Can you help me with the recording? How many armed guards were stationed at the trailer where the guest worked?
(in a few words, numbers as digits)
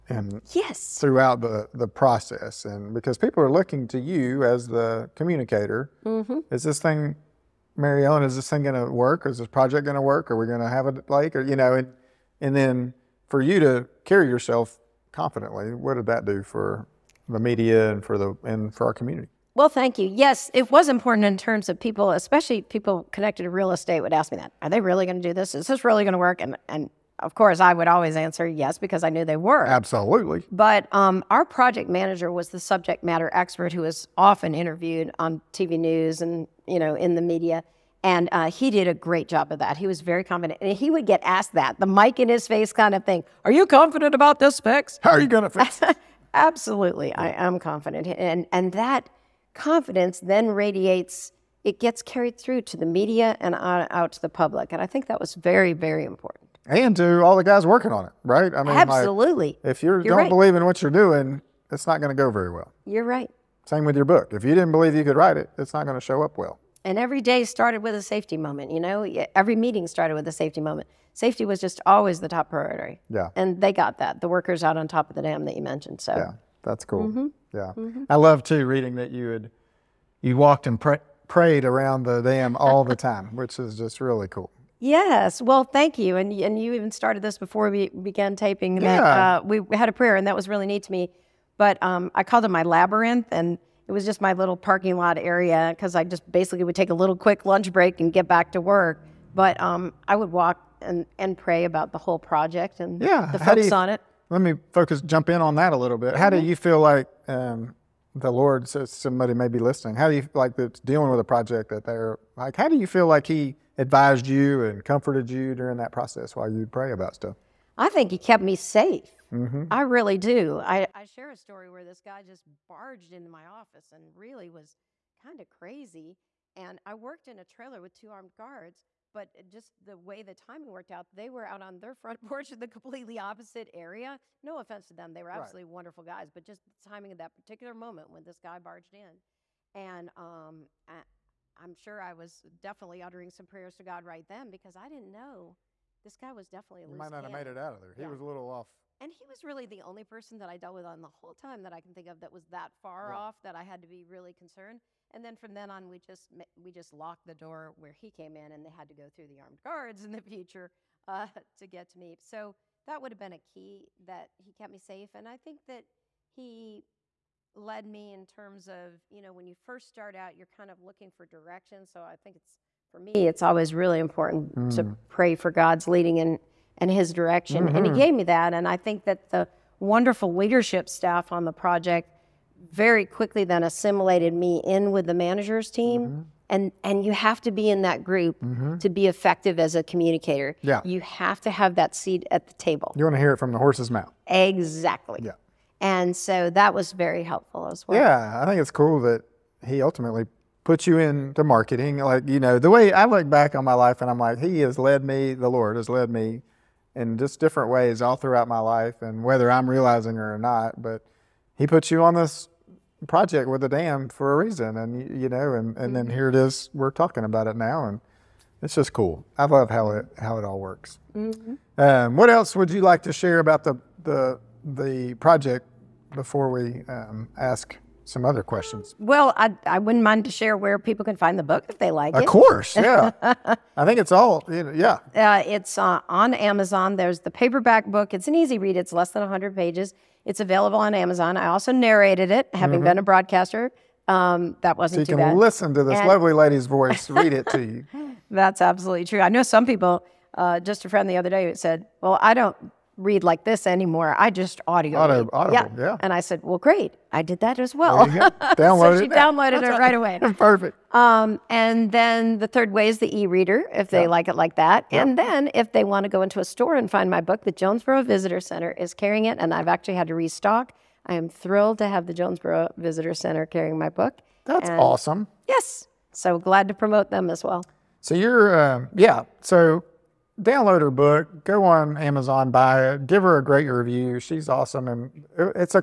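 2.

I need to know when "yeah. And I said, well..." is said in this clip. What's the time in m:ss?
4:15.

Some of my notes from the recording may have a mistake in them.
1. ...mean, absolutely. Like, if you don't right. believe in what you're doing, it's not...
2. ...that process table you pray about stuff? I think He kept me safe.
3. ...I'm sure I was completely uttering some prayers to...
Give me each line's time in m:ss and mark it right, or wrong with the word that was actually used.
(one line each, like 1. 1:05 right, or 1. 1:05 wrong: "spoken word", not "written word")
1. 0:58 right
2. 1:55 wrong: "while", not "table"
3. 2:21 wrong: "definitely", not "completely".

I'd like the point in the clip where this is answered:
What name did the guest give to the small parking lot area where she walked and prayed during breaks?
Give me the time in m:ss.
1:32.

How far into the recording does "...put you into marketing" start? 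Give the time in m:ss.
3:20.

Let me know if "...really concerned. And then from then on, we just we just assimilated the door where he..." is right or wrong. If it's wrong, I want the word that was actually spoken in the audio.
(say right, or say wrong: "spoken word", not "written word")
wrong: "locked", not "assimilated".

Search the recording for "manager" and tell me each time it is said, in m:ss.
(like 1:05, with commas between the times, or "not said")
0:31, 3:05.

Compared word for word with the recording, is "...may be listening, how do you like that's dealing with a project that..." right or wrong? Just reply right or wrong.
right.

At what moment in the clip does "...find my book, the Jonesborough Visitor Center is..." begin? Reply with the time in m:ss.
4:26.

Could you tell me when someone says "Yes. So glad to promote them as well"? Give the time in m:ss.
4:35.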